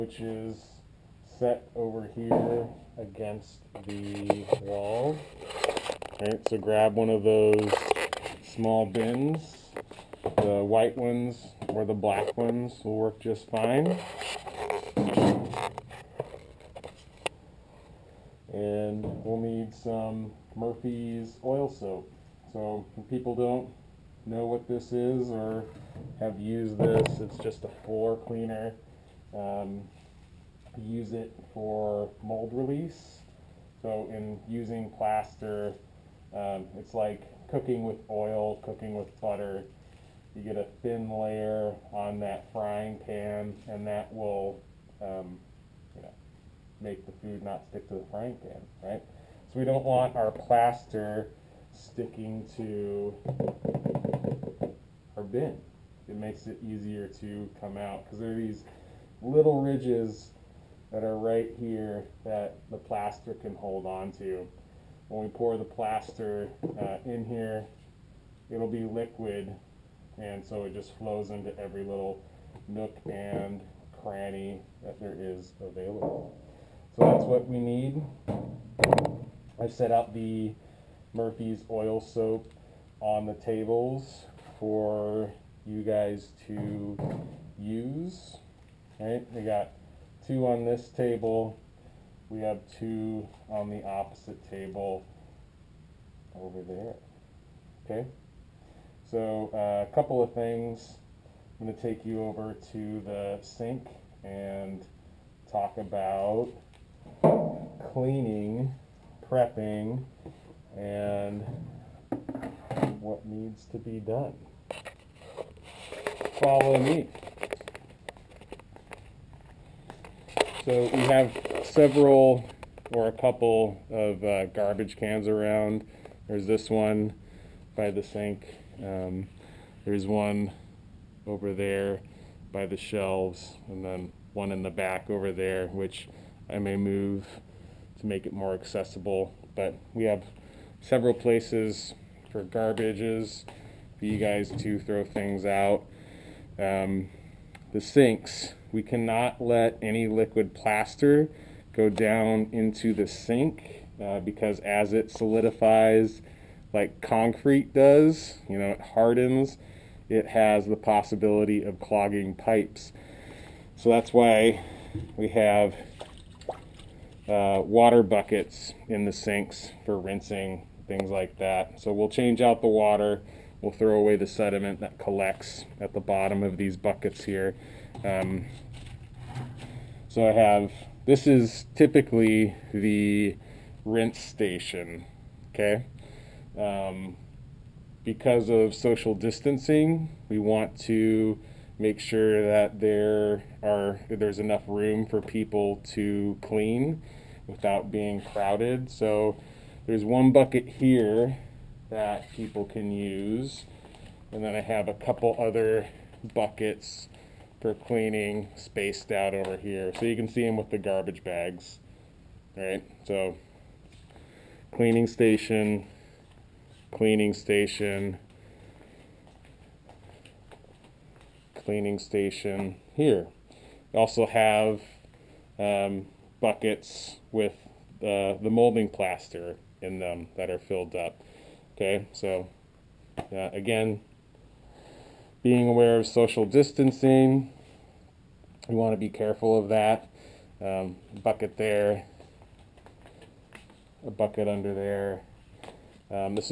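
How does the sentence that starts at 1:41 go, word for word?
I'm going to take you over to the sink and talk about cleaning prepping and what needs to be done.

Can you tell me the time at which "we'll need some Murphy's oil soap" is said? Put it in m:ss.
0:19.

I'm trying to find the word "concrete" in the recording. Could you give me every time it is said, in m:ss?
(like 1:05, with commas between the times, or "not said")
2:37.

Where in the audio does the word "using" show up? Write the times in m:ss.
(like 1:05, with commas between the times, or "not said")
0:34.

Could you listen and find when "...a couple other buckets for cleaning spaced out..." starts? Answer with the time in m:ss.
3:24.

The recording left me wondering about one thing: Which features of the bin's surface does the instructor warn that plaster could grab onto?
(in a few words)
little ridges.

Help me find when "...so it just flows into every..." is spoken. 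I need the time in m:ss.
1:10.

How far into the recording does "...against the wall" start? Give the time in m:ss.
0:02.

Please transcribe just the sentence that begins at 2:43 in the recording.
So that's why we have uh, water buckets in the sinks for rinsing, things like that.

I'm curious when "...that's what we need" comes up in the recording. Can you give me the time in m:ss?
1:17.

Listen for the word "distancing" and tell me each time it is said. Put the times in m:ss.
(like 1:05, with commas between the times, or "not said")
3:09, 3:56.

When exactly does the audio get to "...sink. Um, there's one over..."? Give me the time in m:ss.
2:08.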